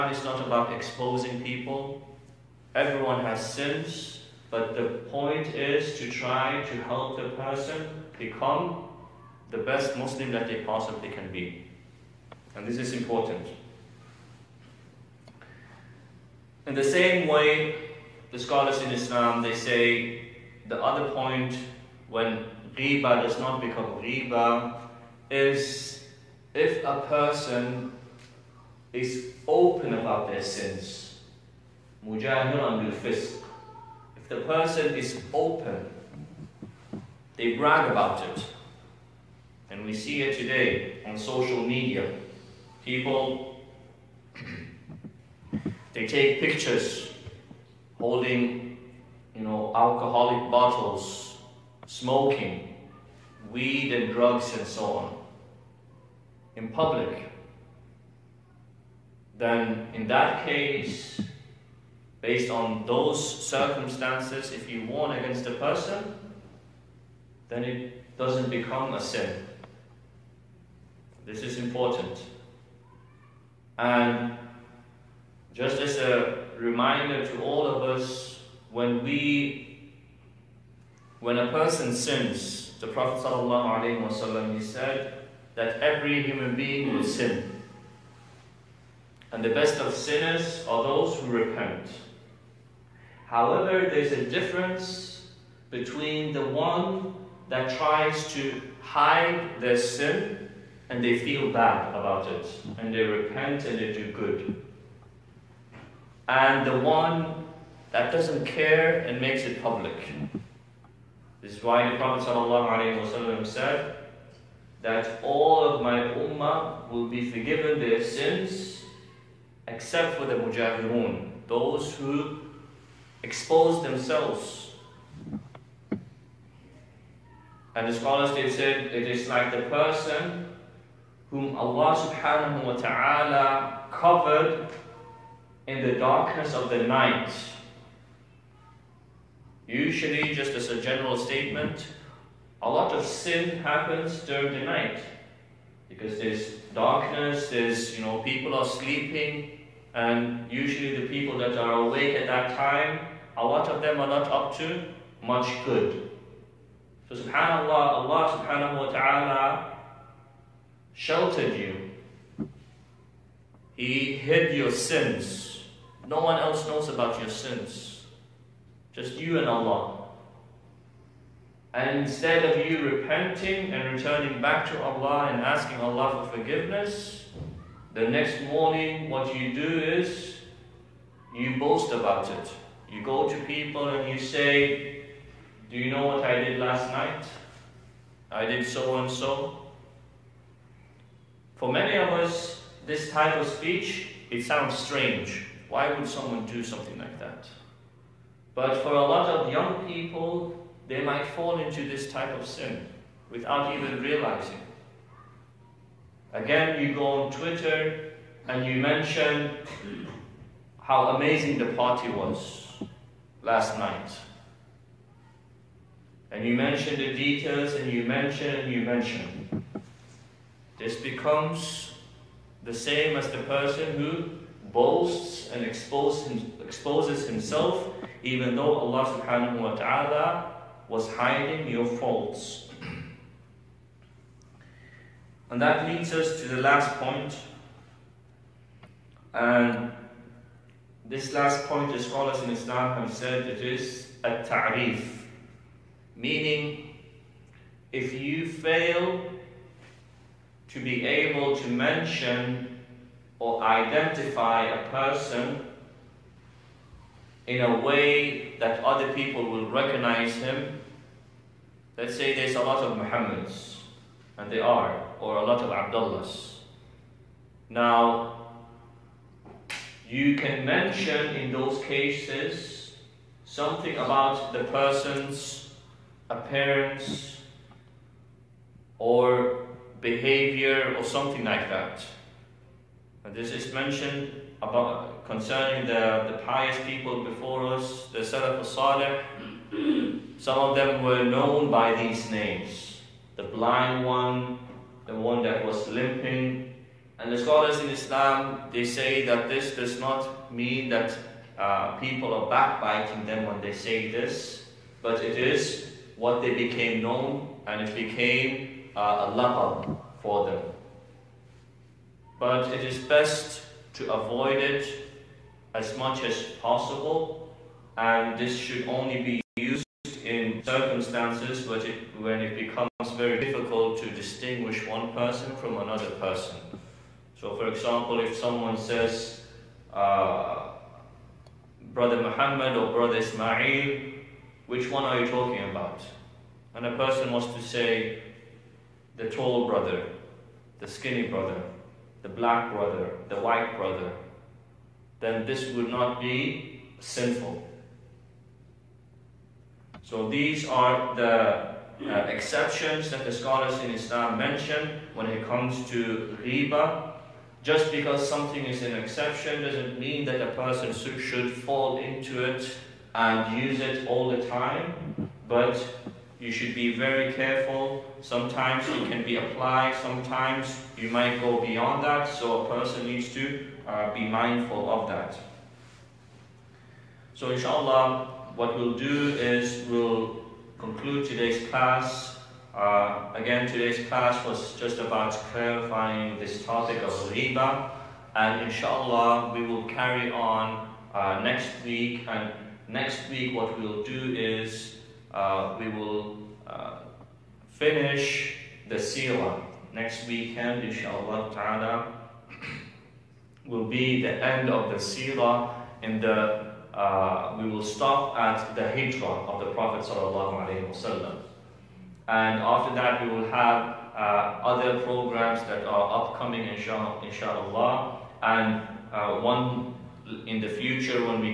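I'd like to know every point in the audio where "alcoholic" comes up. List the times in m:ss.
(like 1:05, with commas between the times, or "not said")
0:49.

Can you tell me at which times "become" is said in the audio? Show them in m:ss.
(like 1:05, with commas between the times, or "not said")
0:08, 0:23, 1:08, 3:41, 5:22.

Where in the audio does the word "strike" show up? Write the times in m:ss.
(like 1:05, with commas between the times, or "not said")
not said.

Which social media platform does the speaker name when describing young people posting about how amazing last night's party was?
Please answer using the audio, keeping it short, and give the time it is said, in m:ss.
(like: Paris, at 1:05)
Twitter, at 3:27.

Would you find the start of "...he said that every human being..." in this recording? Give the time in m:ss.
1:24.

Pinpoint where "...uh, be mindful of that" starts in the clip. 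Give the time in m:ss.
6:13.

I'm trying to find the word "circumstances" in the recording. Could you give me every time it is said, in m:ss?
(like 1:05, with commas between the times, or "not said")
1:03, 5:20.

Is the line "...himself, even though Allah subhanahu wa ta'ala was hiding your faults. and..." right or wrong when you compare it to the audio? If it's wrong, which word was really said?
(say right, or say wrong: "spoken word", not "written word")
right.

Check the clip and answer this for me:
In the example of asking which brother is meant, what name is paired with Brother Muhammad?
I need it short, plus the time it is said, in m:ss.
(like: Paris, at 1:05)
Ismail, at 5:33.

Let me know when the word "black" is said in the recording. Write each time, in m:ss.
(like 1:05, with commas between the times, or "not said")
5:42.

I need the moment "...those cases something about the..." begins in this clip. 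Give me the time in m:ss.
4:31.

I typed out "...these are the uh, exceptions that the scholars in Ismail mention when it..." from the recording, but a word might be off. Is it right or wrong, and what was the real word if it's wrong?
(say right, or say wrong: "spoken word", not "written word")
wrong: "Islam", not "Ismail".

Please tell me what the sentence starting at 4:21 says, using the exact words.
Let's say there's a lot of Muhammads, and they are, or a lot of Abdullahs.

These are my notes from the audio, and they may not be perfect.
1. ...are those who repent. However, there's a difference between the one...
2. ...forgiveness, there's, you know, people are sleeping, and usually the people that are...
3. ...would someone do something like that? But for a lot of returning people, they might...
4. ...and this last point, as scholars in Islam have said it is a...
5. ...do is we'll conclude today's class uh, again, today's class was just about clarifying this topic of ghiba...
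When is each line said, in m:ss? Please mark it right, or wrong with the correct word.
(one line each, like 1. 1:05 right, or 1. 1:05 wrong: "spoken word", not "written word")
1. 1:30 right
2. 2:26 wrong: "darkness", not "forgiveness"
3. 3:15 wrong: "young", not "returning"
4. 3:59 right
5. 6:18 right.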